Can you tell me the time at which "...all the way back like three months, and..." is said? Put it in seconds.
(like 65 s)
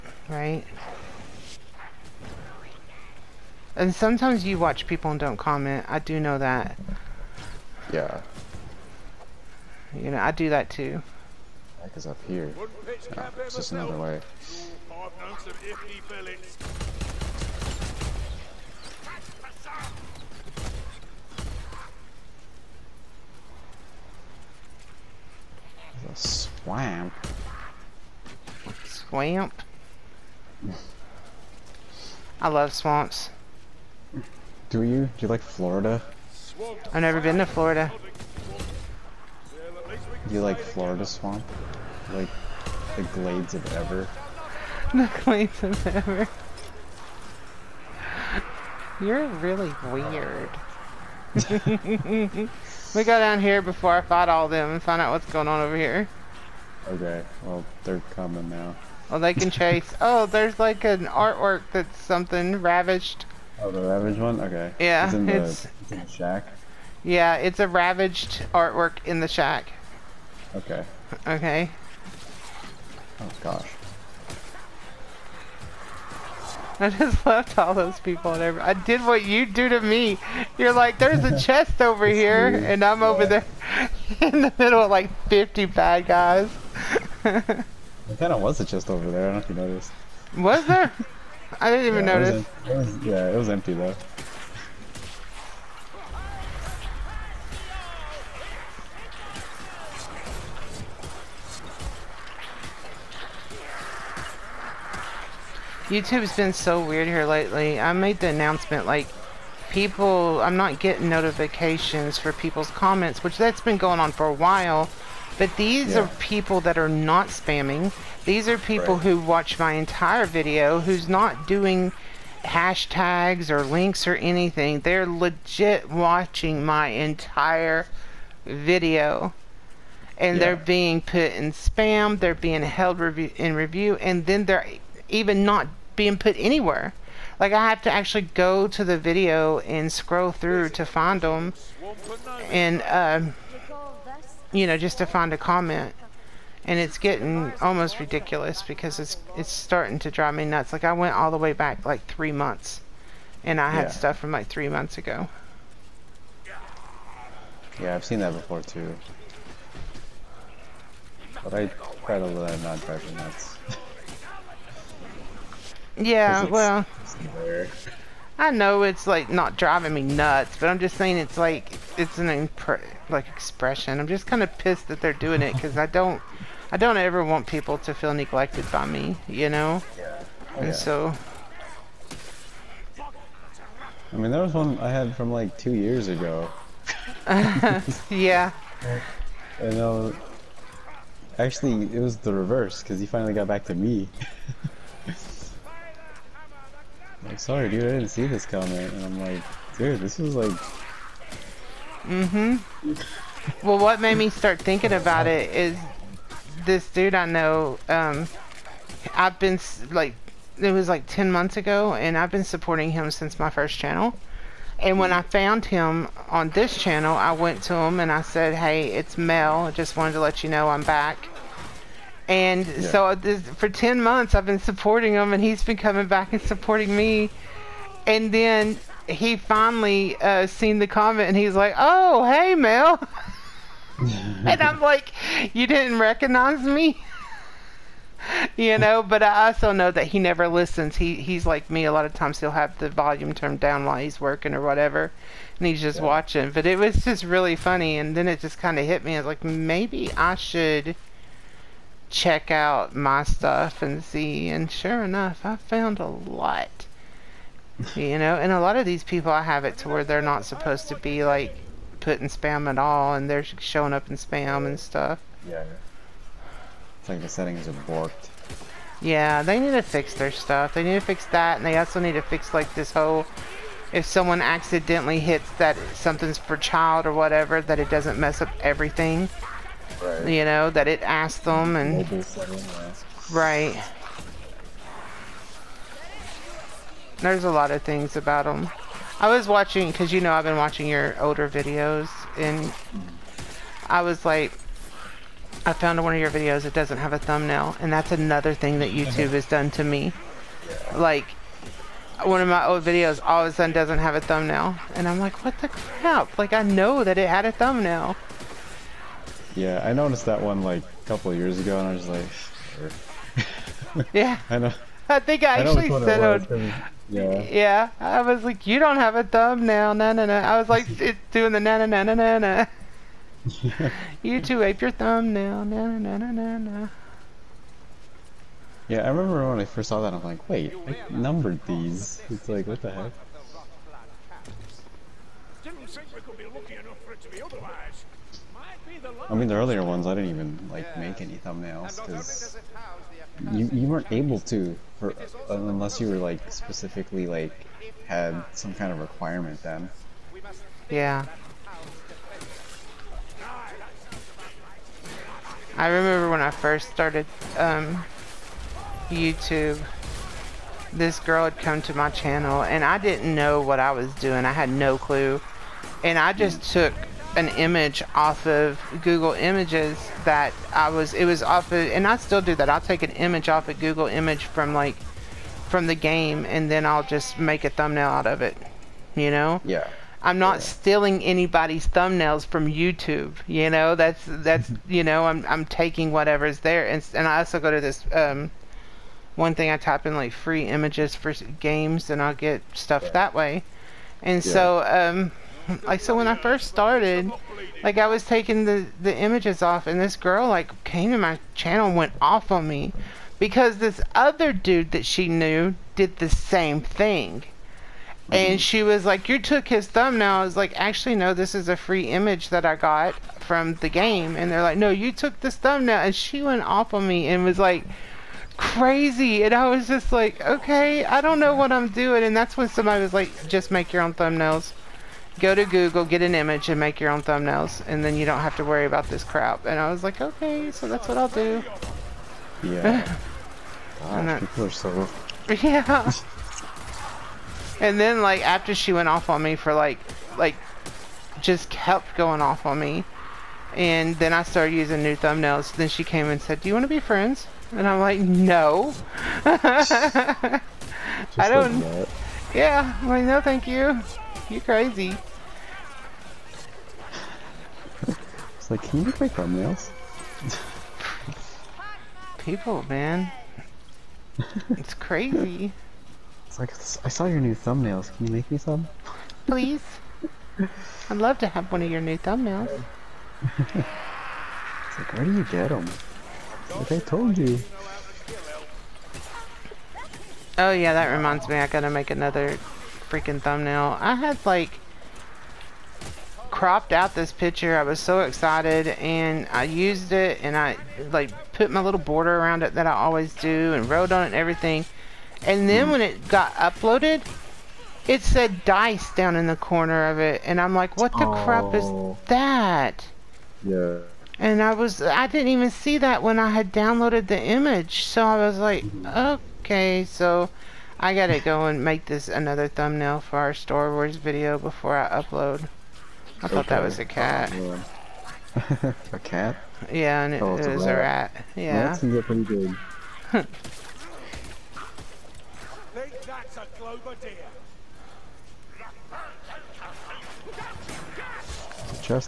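151 s.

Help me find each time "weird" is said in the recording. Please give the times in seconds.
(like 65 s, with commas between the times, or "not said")
49 s, 82 s, 106 s.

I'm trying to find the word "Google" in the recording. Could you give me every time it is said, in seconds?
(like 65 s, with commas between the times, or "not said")
369 s, 373 s, 425 s.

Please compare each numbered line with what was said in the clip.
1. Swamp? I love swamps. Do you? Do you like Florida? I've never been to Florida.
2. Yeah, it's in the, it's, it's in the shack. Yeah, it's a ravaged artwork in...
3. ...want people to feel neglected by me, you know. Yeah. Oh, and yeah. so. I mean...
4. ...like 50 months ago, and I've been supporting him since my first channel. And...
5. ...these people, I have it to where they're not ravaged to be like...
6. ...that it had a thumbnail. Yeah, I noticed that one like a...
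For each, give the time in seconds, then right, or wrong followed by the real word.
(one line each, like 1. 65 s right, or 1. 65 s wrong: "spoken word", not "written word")
1. 28 s right
2. 64 s right
3. 177 s right
4. 210 s wrong: "10", not "50"
5. 258 s wrong: "supposed", not "ravaged"
6. 307 s right.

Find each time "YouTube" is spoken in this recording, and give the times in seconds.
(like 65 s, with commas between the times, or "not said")
105 s, 299 s, 359 s, 382 s.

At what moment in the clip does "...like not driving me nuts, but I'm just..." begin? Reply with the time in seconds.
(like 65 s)
169 s.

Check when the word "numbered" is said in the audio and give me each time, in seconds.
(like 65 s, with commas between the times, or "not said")
331 s.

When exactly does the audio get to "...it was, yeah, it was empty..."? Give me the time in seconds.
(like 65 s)
92 s.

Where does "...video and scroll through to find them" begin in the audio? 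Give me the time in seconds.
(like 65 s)
138 s.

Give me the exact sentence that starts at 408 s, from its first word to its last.
And she was like, "You took his thumbnail." I was like, "Actually, no.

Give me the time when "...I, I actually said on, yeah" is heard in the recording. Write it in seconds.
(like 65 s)
315 s.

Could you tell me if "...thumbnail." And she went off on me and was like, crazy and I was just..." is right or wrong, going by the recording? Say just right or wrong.
right.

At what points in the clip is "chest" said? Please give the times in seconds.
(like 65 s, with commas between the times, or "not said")
81 s, 88 s.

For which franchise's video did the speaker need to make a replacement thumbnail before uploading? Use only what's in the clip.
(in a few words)
Star Wars.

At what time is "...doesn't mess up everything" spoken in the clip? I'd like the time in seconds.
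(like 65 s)
277 s.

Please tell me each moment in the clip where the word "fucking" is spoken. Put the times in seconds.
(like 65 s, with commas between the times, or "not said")
not said.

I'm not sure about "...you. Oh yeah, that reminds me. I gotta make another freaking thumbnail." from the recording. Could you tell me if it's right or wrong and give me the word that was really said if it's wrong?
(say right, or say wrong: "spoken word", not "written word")
right.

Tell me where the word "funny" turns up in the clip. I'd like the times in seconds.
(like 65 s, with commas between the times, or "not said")
247 s.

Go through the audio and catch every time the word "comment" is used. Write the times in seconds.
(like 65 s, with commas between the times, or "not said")
5 s, 112 s, 145 s, 198 s, 230 s.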